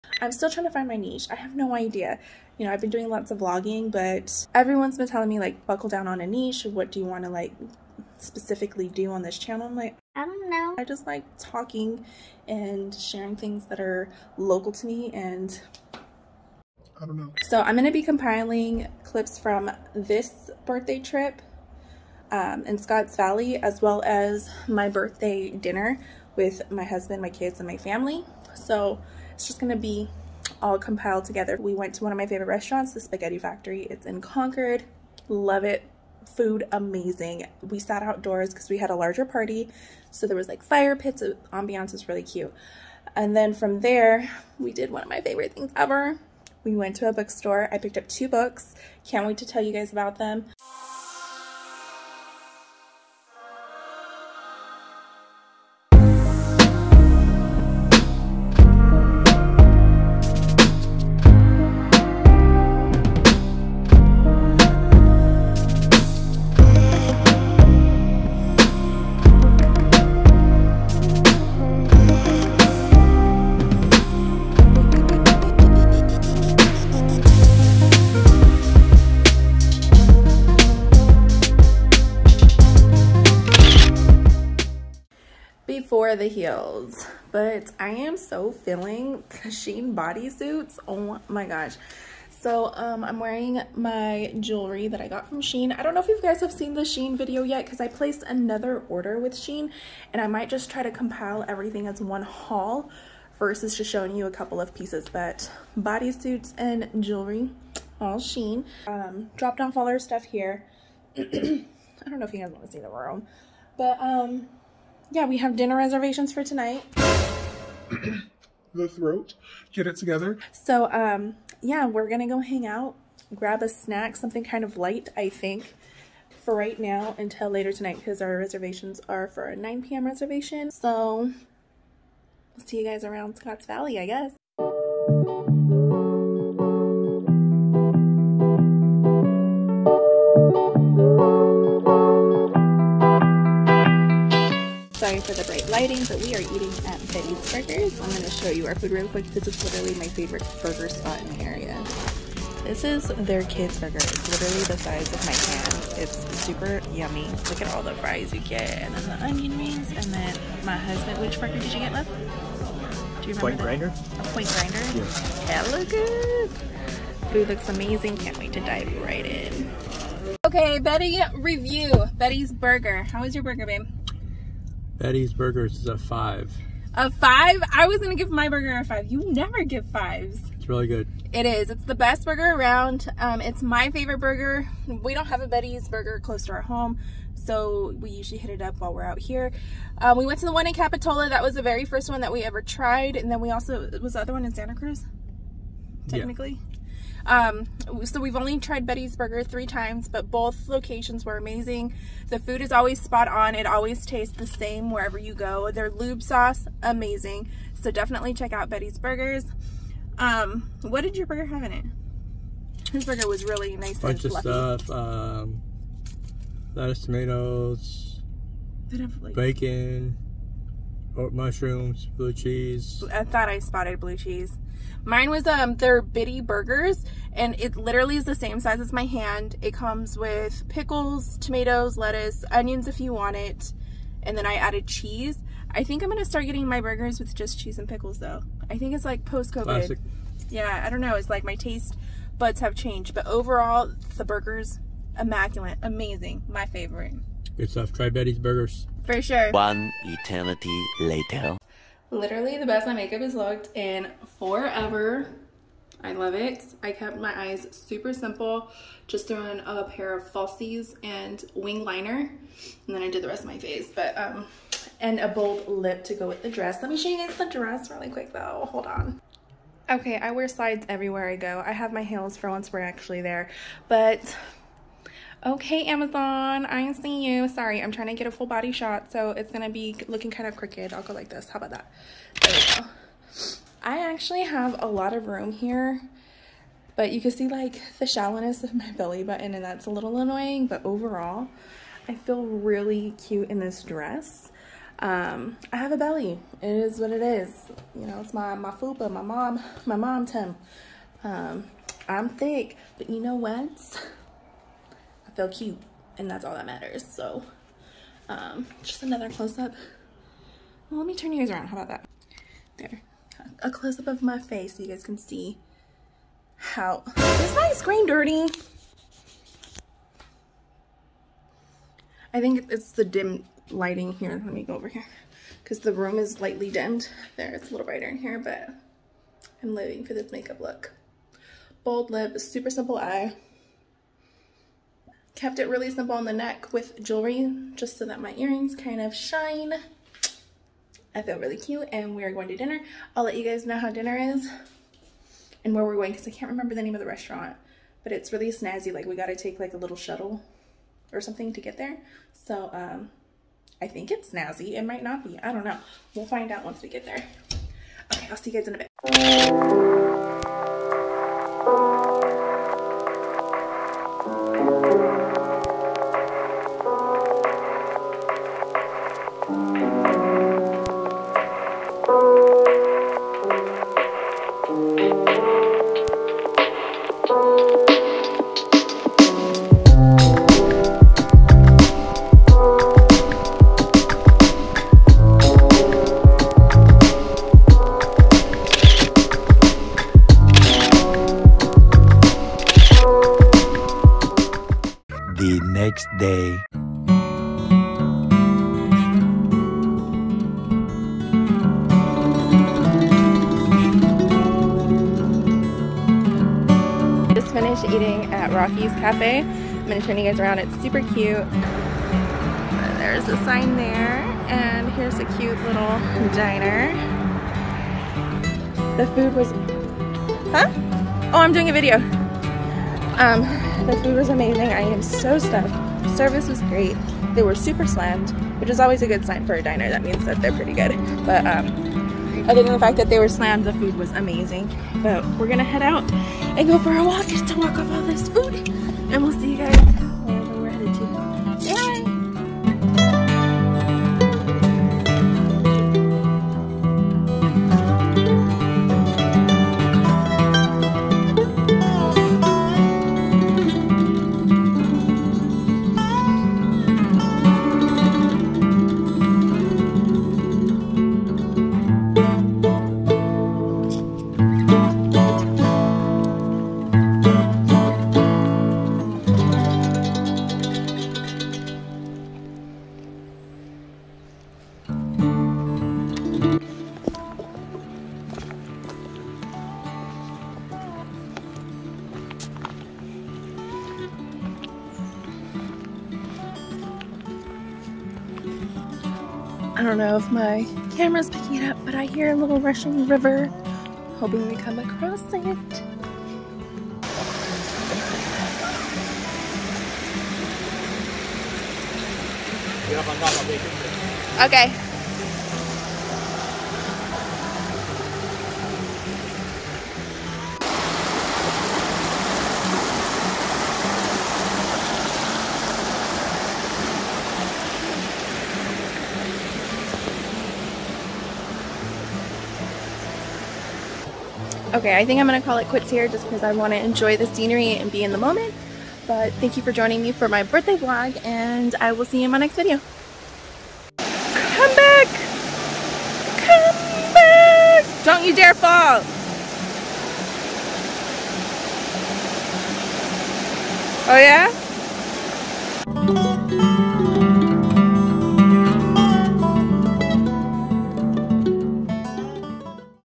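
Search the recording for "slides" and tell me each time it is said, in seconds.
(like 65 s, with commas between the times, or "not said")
270 s.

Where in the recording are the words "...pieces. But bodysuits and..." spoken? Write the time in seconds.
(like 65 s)
104 s.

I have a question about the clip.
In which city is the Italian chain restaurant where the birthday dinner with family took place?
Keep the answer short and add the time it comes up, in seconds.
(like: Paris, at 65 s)
Concord, at 33 s.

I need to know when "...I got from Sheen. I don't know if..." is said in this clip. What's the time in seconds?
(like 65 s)
95 s.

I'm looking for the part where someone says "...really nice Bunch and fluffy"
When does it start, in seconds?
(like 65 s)
213 s.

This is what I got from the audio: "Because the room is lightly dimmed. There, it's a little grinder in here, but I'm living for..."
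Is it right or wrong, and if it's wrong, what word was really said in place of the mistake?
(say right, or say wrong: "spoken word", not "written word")
wrong: "brighter", not "grinder".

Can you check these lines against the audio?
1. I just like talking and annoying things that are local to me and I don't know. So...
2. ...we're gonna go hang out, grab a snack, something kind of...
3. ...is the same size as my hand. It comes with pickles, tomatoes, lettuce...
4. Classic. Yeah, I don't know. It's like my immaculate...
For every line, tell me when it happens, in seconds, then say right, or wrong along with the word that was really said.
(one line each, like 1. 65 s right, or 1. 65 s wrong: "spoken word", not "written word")
1. 10 s wrong: "sharing", not "annoying"
2. 121 s right
3. 228 s right
4. 239 s wrong: "taste", not "immaculate".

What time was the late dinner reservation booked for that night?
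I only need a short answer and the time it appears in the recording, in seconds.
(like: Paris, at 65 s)
9 p.m., at 129 s.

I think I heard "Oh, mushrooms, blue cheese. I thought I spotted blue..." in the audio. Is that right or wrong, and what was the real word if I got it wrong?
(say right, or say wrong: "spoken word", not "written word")
right.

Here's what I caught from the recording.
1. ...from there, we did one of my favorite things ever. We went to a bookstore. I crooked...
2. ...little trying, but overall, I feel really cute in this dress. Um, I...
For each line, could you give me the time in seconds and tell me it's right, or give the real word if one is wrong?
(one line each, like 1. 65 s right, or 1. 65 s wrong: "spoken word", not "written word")
1. 43 s wrong: "picked", not "crooked"
2. 289 s wrong: "annoying", not "trying".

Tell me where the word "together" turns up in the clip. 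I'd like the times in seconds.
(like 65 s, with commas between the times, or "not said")
31 s, 119 s.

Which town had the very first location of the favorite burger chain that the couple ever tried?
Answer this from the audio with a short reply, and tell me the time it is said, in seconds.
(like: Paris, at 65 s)
Capitola, at 190 s.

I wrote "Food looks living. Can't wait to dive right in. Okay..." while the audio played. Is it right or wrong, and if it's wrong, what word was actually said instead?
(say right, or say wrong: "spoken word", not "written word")
wrong: "amazing", not "living".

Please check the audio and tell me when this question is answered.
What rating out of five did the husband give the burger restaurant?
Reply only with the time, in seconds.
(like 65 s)
175 s.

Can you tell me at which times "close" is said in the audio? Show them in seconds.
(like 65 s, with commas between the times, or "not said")
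186 s, 309 s, 313 s.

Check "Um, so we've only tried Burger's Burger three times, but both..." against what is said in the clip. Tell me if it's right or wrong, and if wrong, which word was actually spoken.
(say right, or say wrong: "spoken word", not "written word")
wrong: "Betty", not "Burger".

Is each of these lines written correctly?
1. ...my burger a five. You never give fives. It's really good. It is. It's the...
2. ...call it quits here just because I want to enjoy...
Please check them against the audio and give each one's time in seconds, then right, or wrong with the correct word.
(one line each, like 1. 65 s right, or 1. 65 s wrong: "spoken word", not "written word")
1. 178 s right
2. 525 s right.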